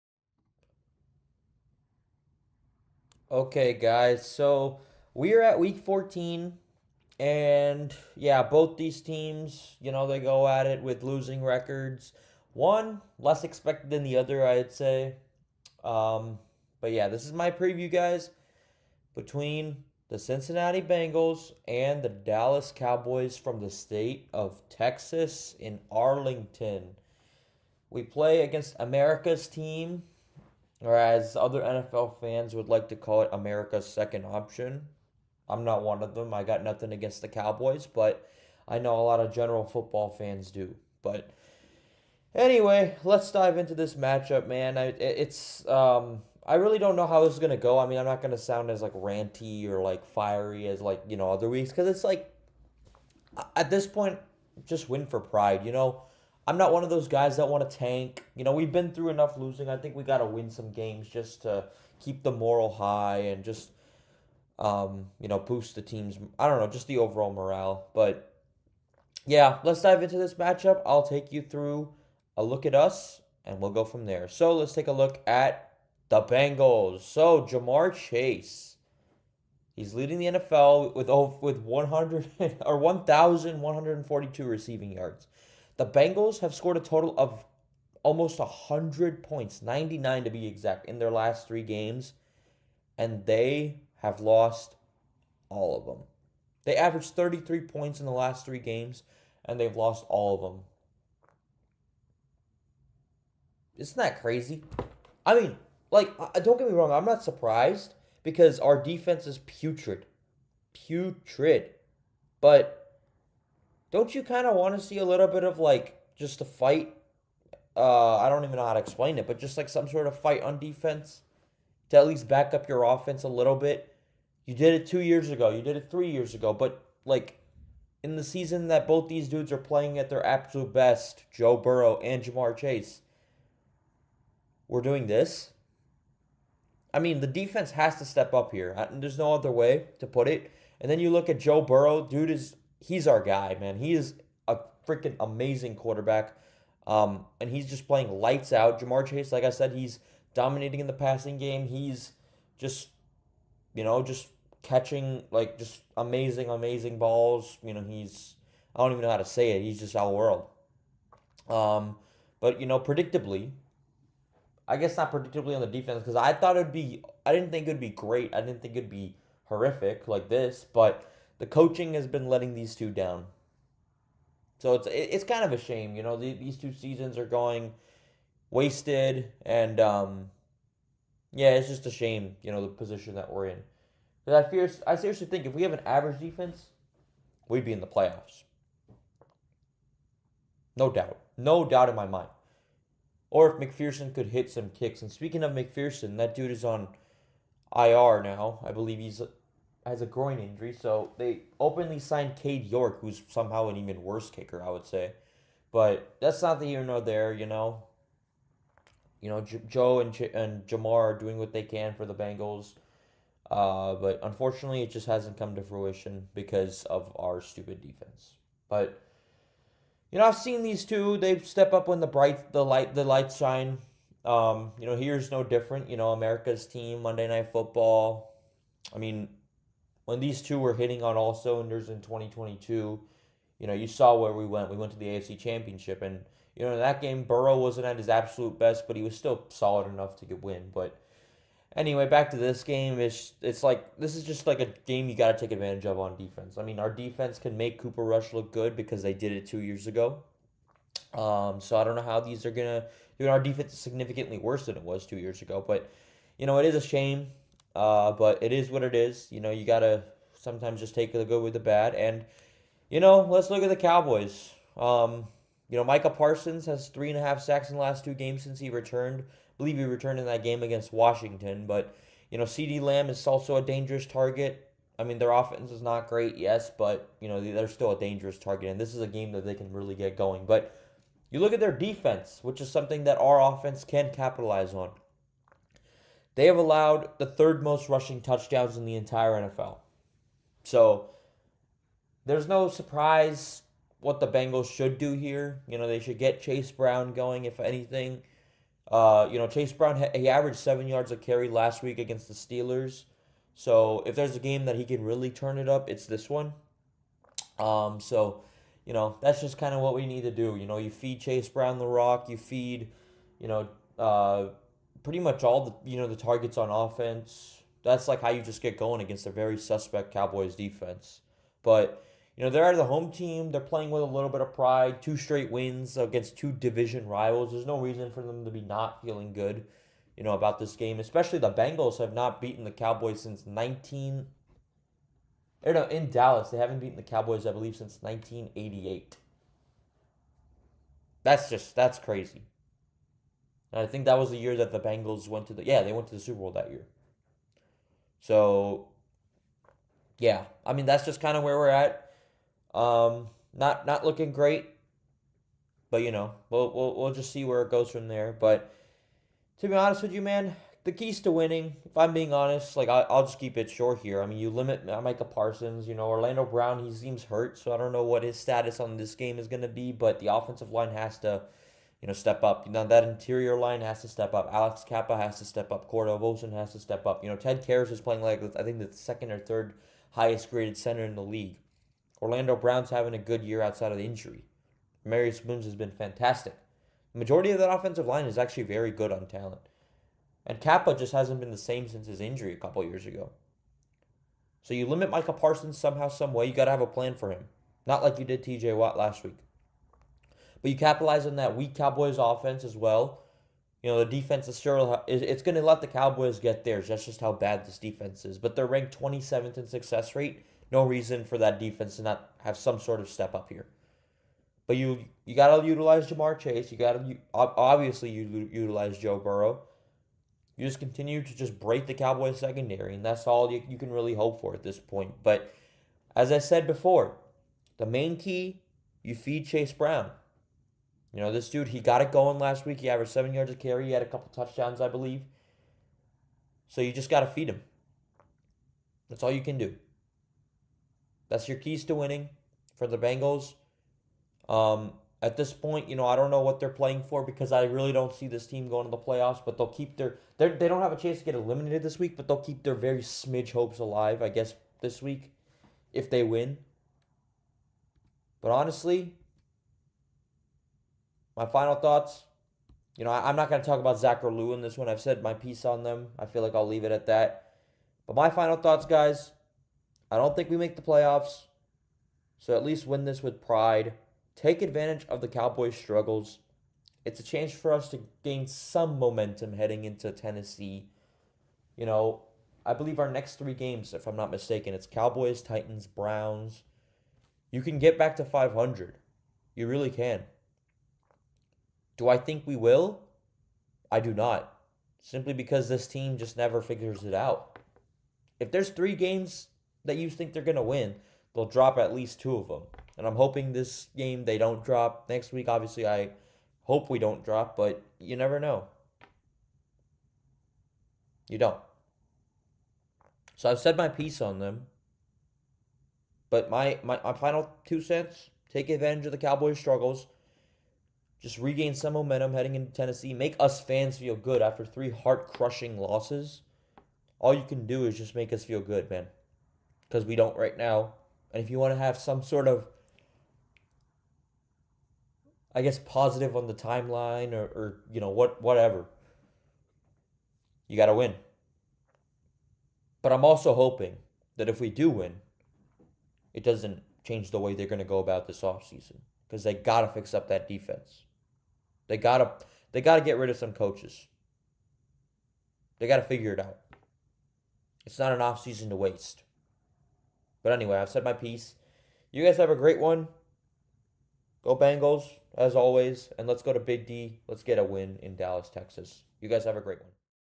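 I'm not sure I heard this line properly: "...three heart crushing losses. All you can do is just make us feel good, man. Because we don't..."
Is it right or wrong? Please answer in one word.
right.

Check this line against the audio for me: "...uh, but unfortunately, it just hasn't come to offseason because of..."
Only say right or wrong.
wrong.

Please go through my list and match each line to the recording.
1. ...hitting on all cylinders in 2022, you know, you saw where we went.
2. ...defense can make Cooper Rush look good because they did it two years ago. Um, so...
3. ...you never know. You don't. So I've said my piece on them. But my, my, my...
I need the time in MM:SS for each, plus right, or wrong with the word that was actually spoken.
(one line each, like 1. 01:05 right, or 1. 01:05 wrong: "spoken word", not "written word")
1. 03:50 right
2. 04:06 right
3. 08:27 right.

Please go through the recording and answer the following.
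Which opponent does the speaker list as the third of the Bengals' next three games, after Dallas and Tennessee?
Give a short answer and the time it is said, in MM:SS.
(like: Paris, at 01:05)
Browns, at 08:05.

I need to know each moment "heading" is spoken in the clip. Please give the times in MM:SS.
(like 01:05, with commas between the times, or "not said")
07:59, 08:42.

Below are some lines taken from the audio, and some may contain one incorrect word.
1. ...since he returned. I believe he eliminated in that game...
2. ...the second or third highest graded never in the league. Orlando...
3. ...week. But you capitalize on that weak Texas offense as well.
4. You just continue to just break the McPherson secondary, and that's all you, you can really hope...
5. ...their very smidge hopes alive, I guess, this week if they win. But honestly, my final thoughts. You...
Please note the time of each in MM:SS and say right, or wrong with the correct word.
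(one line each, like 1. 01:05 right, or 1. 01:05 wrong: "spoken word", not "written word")
1. 04:28 wrong: "returned", not "eliminated"
2. 06:18 wrong: "center", not "never"
3. 06:39 wrong: "Cowboys", not "Texas"
4. 07:00 wrong: "Cowboys", not "McPherson"
5. 07:32 right.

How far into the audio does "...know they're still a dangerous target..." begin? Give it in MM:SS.
04:37.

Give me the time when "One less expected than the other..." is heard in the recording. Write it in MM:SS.
00:12.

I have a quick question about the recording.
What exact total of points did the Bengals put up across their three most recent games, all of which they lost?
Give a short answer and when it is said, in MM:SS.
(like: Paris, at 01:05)
99, at 01:29.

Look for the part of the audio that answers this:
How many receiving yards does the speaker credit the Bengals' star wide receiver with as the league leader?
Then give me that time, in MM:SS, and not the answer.
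01:22.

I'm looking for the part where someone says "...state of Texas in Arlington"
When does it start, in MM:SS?
00:23.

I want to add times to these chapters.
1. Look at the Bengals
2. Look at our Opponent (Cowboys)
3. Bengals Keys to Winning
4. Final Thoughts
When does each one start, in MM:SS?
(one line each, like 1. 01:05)
1. 01:16
2. 04:22
3. 06:02
4. 07:38.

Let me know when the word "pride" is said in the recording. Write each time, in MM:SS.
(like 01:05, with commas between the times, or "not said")
00:55, 05:24, 07:53.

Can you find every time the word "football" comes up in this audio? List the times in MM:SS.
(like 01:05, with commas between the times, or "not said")
00:39, 03:47.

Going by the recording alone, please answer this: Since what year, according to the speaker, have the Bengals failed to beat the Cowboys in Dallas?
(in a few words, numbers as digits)
1988.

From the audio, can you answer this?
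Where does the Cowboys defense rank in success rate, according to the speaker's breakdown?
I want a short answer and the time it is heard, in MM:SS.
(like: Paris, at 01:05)
27th, at 06:48.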